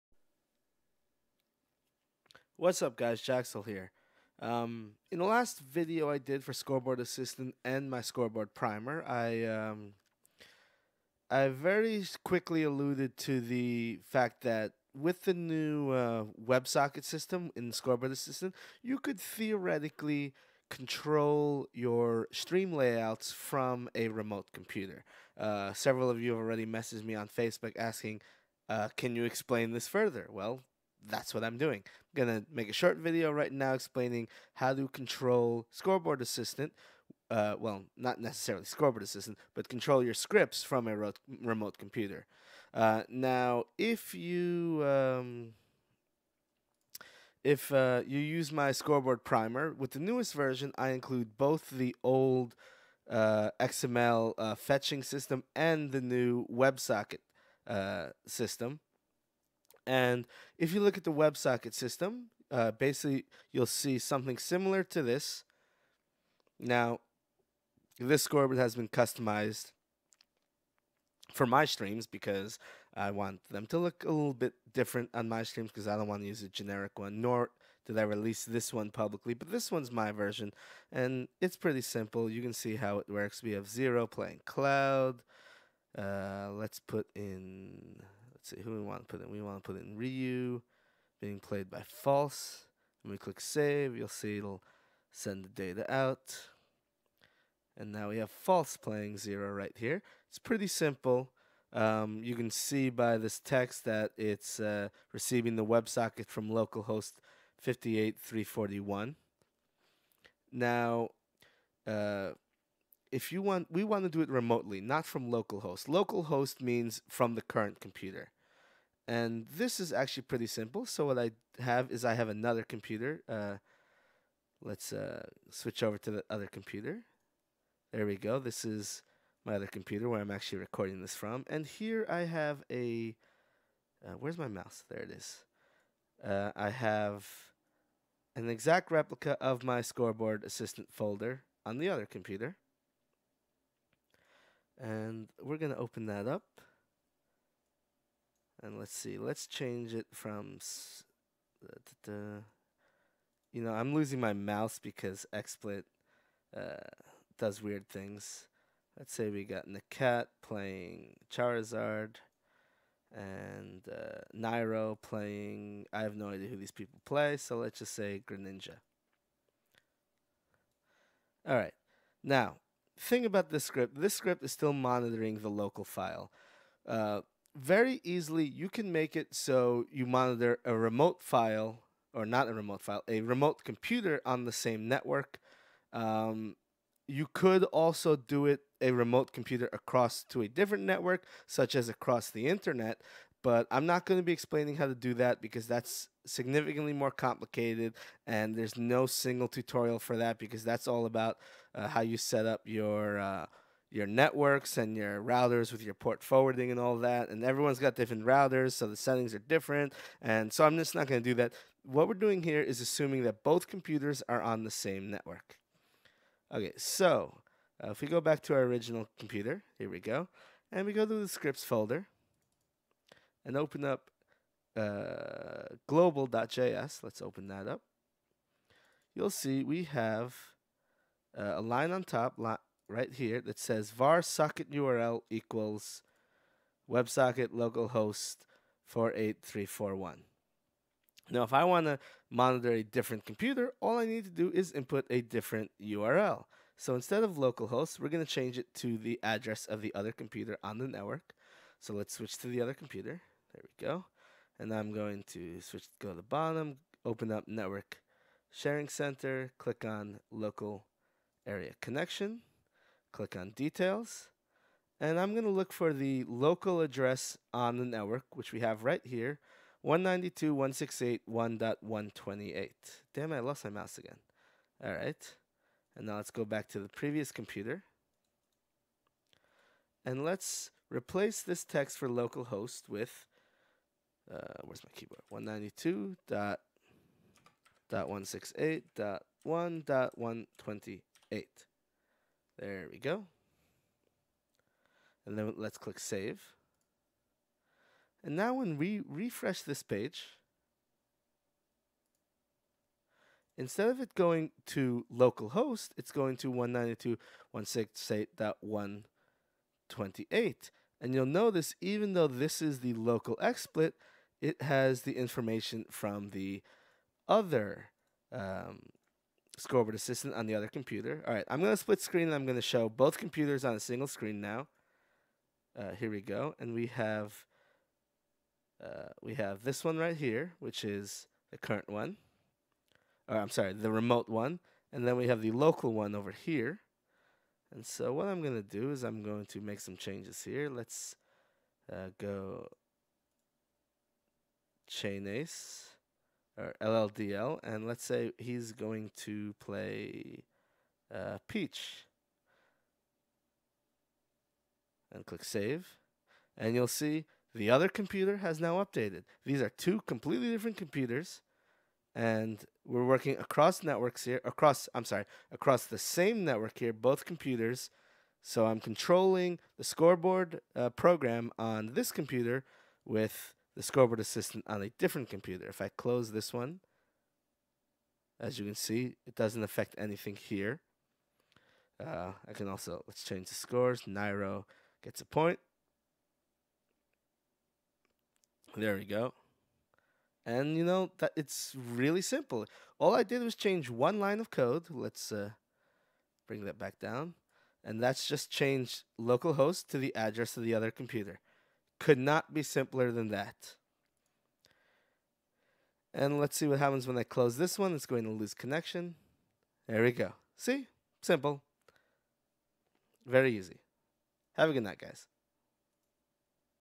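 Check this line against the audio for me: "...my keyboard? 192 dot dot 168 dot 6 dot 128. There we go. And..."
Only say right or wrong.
wrong.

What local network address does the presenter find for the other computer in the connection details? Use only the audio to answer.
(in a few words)
192.168.1.128.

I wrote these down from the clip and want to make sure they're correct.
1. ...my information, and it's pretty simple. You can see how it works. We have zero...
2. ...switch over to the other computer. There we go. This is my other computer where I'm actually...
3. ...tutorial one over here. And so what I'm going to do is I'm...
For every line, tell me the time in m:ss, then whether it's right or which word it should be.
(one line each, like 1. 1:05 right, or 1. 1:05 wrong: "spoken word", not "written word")
1. 1:19 wrong: "version", not "information"
2. 2:05 right
3. 5:35 wrong: "local", not "tutorial".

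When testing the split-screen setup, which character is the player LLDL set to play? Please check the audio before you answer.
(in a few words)
Peach.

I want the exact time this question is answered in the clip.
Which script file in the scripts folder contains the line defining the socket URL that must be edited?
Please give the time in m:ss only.
3:45.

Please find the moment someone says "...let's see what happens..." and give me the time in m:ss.
6:46.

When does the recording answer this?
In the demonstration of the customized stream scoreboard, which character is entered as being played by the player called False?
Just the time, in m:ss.
1:29.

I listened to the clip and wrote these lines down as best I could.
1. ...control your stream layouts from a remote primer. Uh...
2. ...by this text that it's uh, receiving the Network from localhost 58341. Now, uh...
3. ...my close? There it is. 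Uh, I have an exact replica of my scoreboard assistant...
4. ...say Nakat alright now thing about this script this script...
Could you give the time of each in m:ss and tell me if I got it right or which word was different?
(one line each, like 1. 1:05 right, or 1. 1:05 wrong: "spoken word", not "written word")
1. 0:20 wrong: "computer", not "primer"
2. 1:42 wrong: "WebSocket", not "Network"
3. 2:14 wrong: "mouse", not "close"
4. 2:47 wrong: "Greninja", not "Nakat".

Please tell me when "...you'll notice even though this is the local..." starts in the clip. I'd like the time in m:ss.
5:11.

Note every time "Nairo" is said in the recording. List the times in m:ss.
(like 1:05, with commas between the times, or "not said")
2:44, 6:24.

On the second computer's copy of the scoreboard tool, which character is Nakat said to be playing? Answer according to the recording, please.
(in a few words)
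Charizard.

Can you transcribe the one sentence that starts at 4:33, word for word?
Damn, I lost my mouse again.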